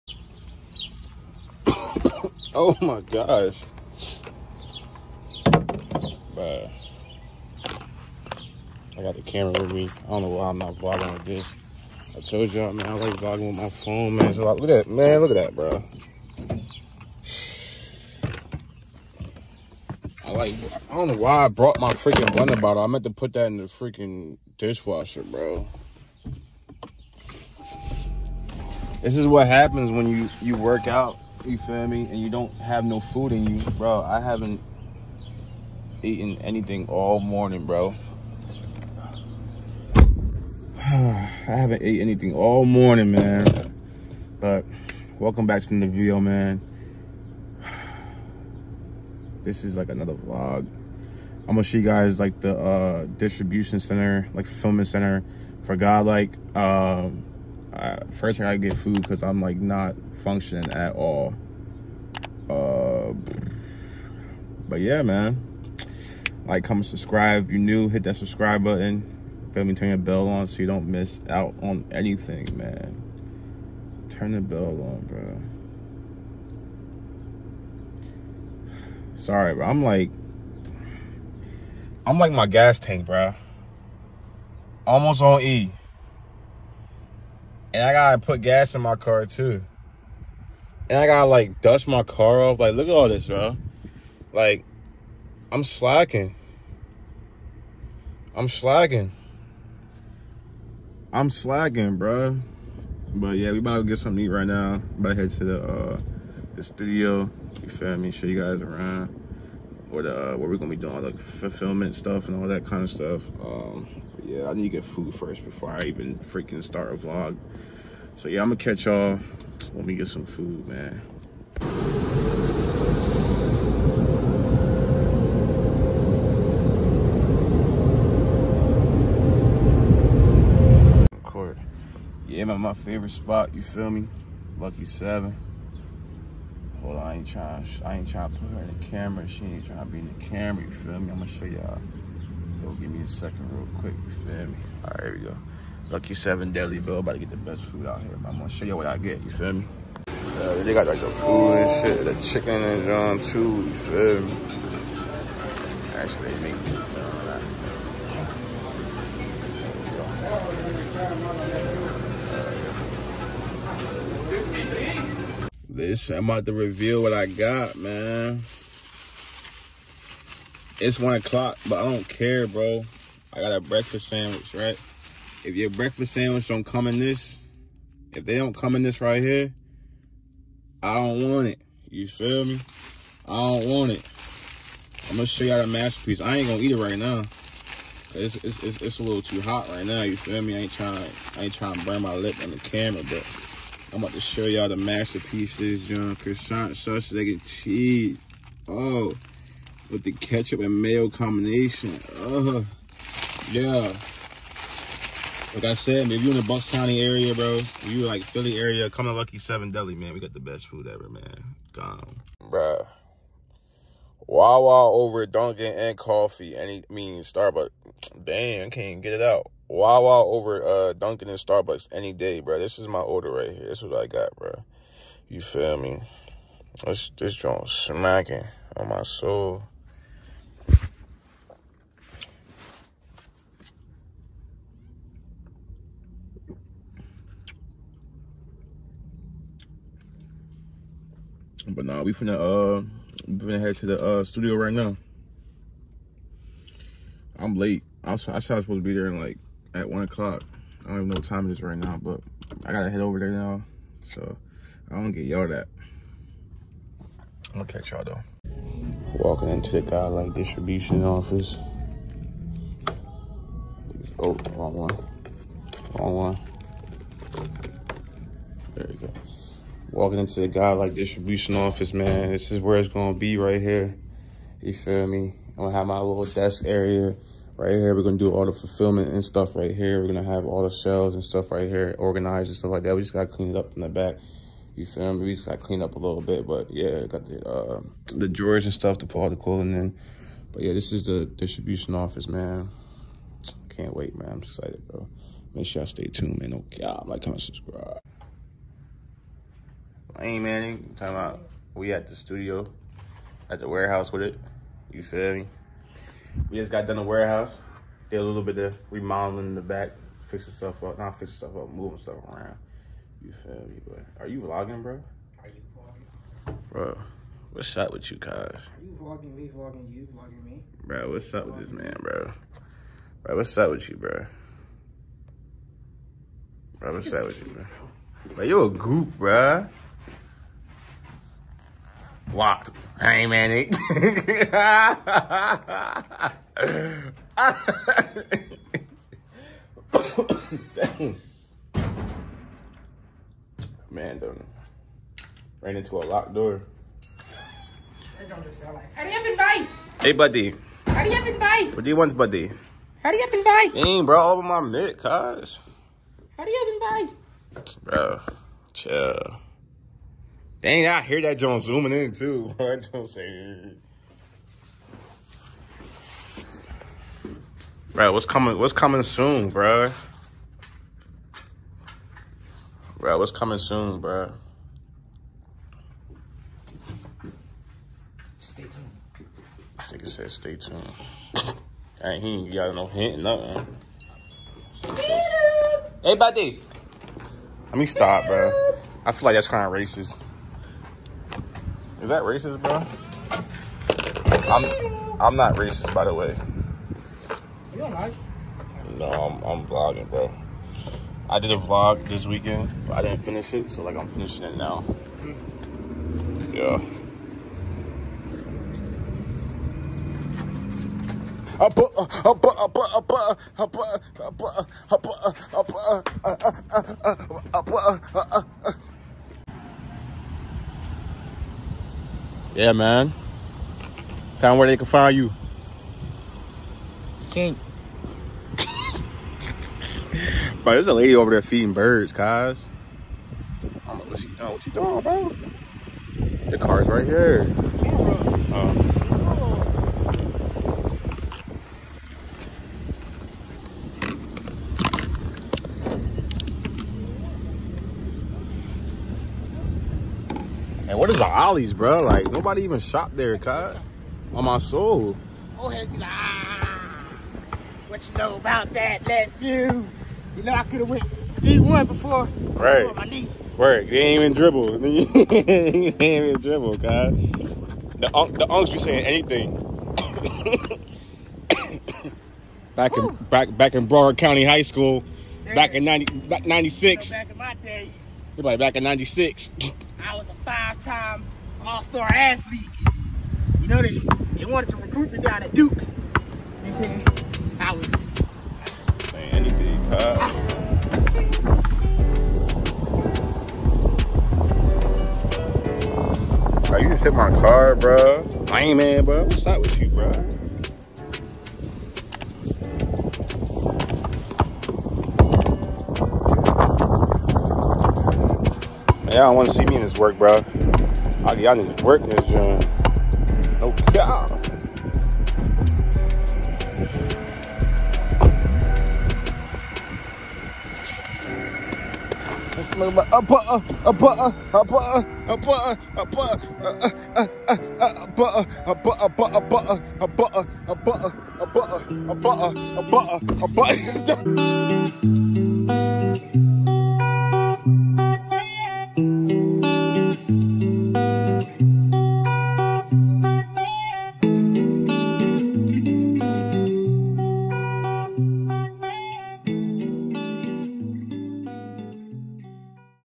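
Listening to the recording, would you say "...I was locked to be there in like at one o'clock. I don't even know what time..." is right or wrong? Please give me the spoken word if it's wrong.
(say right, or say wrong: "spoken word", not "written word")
wrong: "supposed", not "locked".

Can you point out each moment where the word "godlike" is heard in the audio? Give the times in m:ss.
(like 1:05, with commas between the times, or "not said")
4:19, 4:30.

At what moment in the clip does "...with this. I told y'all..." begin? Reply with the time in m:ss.
0:11.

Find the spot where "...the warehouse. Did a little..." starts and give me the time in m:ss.
5:06.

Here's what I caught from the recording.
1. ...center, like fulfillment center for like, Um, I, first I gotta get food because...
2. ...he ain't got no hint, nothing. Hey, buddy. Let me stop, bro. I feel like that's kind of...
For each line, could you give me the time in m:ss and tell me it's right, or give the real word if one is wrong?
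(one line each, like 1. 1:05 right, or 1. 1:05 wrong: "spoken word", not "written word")
1. 0:53 right
2. 6:22 right.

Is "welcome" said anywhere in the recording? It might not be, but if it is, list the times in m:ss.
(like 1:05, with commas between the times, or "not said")
0:45.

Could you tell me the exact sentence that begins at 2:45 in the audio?
Listen, I'm about to reveal what I got, man.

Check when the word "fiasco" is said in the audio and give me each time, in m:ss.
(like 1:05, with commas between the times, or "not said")
not said.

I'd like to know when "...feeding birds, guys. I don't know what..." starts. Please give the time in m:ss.
7:11.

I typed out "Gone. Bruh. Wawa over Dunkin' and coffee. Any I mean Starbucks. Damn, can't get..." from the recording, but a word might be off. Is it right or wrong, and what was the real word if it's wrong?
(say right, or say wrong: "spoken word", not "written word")
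right.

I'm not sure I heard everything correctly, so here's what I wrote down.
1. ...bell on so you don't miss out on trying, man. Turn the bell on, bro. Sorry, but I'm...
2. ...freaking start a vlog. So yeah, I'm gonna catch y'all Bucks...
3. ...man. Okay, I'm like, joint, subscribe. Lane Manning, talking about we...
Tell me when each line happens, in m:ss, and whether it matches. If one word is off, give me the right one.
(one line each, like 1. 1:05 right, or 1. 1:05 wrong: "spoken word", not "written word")
1. 1:09 wrong: "anything", not "trying"
2. 1:56 wrong: "Let", not "Bucks"
3. 4:56 wrong: "comment", not "joint".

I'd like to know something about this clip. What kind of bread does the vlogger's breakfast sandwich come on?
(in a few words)
Croissant.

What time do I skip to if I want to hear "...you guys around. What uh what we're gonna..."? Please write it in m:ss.
1:48.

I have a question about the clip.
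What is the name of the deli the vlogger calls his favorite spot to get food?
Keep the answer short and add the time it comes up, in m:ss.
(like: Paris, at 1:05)
Lucky Seven Deli, at 2:25.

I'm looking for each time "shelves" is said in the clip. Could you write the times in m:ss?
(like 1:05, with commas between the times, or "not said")
4:40.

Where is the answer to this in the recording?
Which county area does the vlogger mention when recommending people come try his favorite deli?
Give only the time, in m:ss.
3:26.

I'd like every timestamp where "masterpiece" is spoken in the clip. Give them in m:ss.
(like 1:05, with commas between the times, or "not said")
3:05, 3:14.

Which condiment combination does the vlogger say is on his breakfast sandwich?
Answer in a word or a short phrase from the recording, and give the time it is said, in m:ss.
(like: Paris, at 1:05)
ketchup and mayo, at 3:20.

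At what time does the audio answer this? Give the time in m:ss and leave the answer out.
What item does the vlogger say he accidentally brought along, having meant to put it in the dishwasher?
0:22.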